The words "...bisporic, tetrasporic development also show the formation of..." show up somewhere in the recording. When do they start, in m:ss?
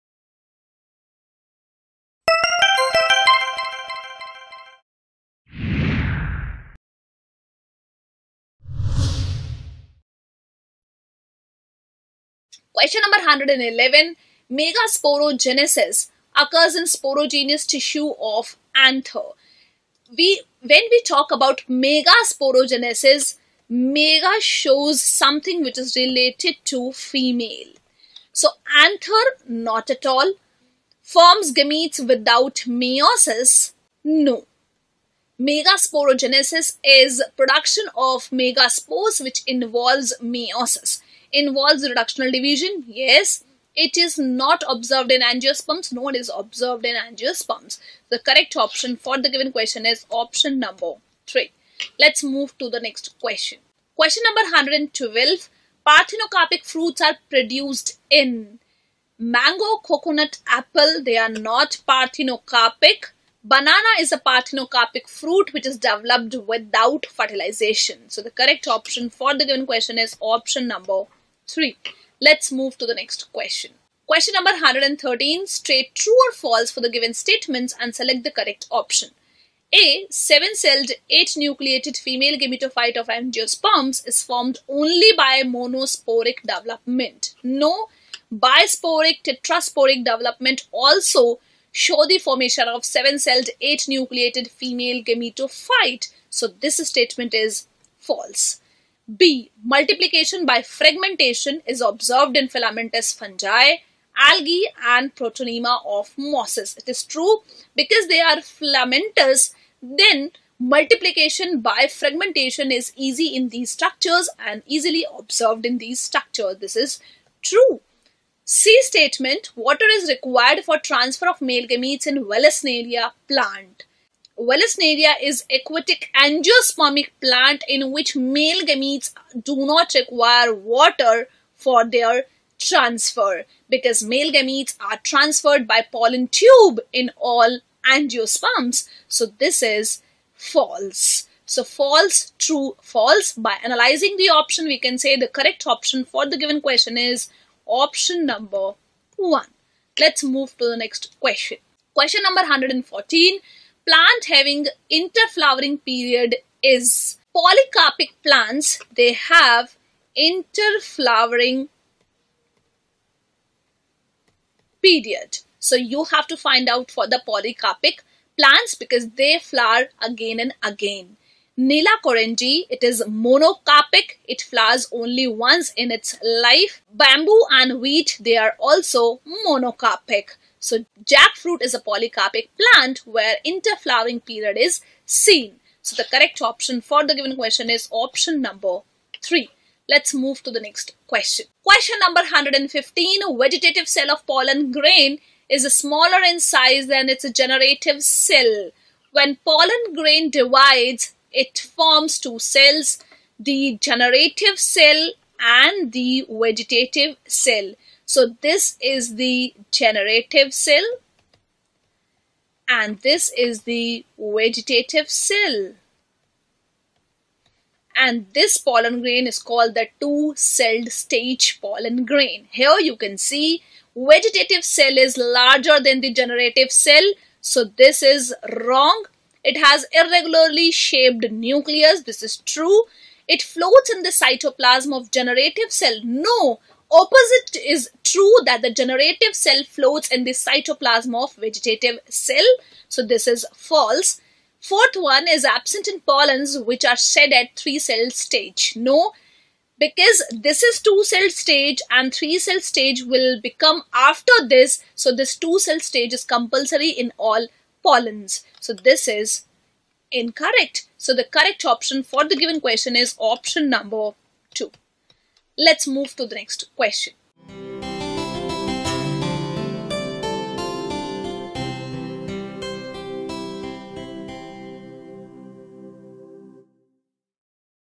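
1:28.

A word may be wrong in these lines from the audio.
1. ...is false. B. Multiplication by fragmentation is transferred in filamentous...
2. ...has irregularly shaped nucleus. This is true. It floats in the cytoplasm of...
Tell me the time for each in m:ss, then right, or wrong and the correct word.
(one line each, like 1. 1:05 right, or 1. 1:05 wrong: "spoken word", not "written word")
1. 1:37 wrong: "observed", not "transferred"
2. 3:49 right.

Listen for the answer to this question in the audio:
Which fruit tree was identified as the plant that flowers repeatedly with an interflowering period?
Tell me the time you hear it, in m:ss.
3:01.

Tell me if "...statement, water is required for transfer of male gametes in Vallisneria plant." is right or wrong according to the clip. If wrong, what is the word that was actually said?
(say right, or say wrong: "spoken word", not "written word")
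right.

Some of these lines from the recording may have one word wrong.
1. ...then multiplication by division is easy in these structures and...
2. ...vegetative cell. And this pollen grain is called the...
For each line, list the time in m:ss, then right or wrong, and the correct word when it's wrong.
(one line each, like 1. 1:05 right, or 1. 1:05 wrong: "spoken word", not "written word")
1. 1:49 wrong: "fragmentation", not "division"
2. 3:34 right.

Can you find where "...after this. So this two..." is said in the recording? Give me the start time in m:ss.
4:13.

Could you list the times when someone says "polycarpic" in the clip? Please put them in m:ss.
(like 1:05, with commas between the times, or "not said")
2:37, 2:47, 3:01.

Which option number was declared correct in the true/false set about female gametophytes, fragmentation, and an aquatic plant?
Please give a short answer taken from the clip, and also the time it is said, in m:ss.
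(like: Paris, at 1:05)
1, at 2:27.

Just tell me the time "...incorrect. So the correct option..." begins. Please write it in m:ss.
4:20.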